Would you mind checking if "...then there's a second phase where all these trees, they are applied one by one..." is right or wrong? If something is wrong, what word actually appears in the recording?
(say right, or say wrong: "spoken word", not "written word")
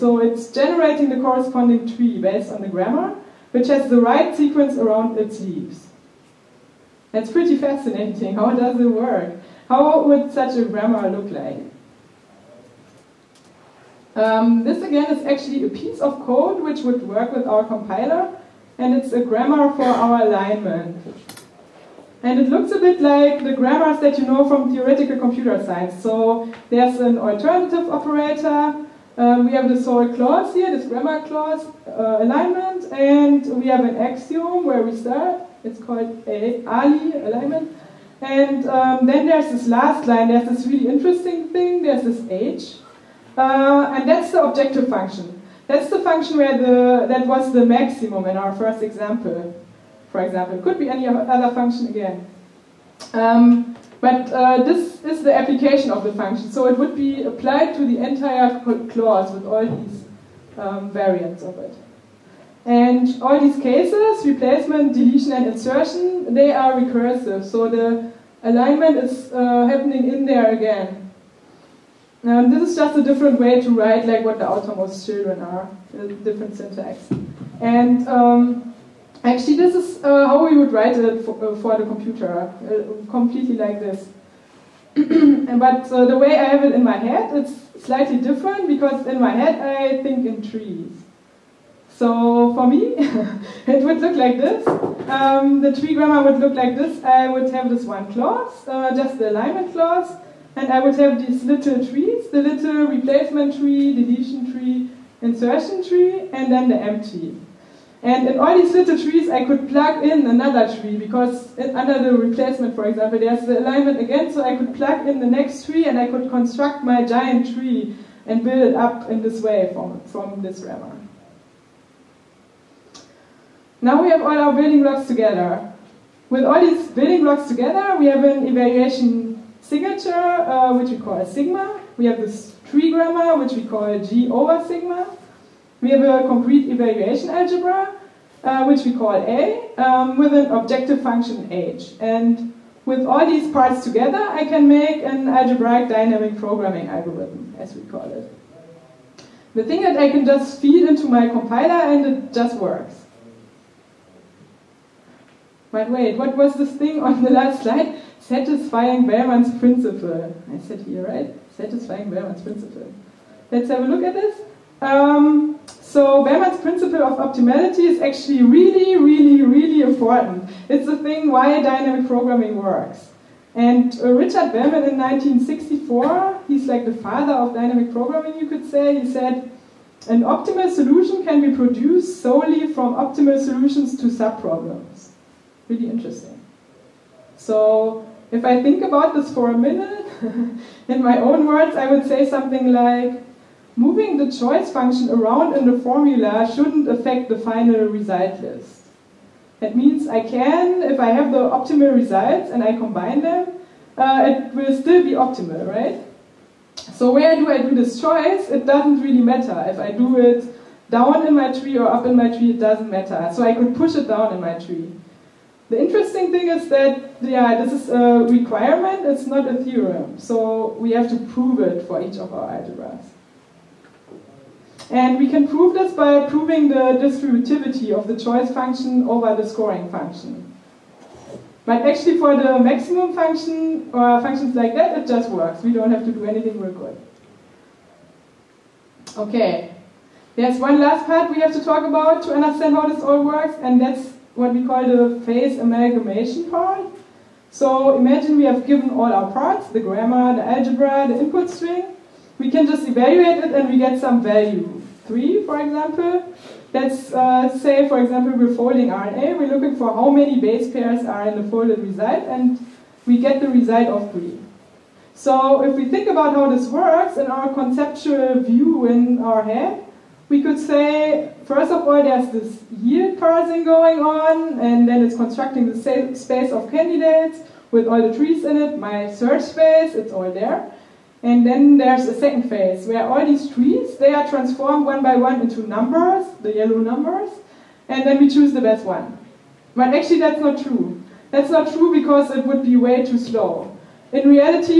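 wrong: "transformed", not "applied".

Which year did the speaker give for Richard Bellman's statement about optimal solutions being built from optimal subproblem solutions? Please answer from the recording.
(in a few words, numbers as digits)
1964.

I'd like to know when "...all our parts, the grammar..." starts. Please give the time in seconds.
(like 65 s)
248 s.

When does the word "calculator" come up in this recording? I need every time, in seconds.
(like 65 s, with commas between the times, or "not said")
not said.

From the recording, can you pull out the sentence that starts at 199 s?
That means I can, if I have the optimal results and I combine them, uh, it will still be optimal, right?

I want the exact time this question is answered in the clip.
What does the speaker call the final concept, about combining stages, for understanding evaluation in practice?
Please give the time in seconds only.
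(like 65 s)
245 s.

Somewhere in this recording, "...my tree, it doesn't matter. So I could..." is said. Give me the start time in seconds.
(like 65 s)
212 s.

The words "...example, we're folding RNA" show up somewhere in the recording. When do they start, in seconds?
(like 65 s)
258 s.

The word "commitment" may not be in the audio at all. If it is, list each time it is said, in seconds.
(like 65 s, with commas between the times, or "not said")
not said.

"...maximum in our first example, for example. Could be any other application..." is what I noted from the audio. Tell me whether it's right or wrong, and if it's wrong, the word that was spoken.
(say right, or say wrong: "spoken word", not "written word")
wrong: "function", not "application".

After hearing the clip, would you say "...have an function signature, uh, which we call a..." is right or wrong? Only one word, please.
wrong.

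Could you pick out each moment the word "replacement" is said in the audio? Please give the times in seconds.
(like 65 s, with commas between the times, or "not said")
64 s, 102 s, 112 s.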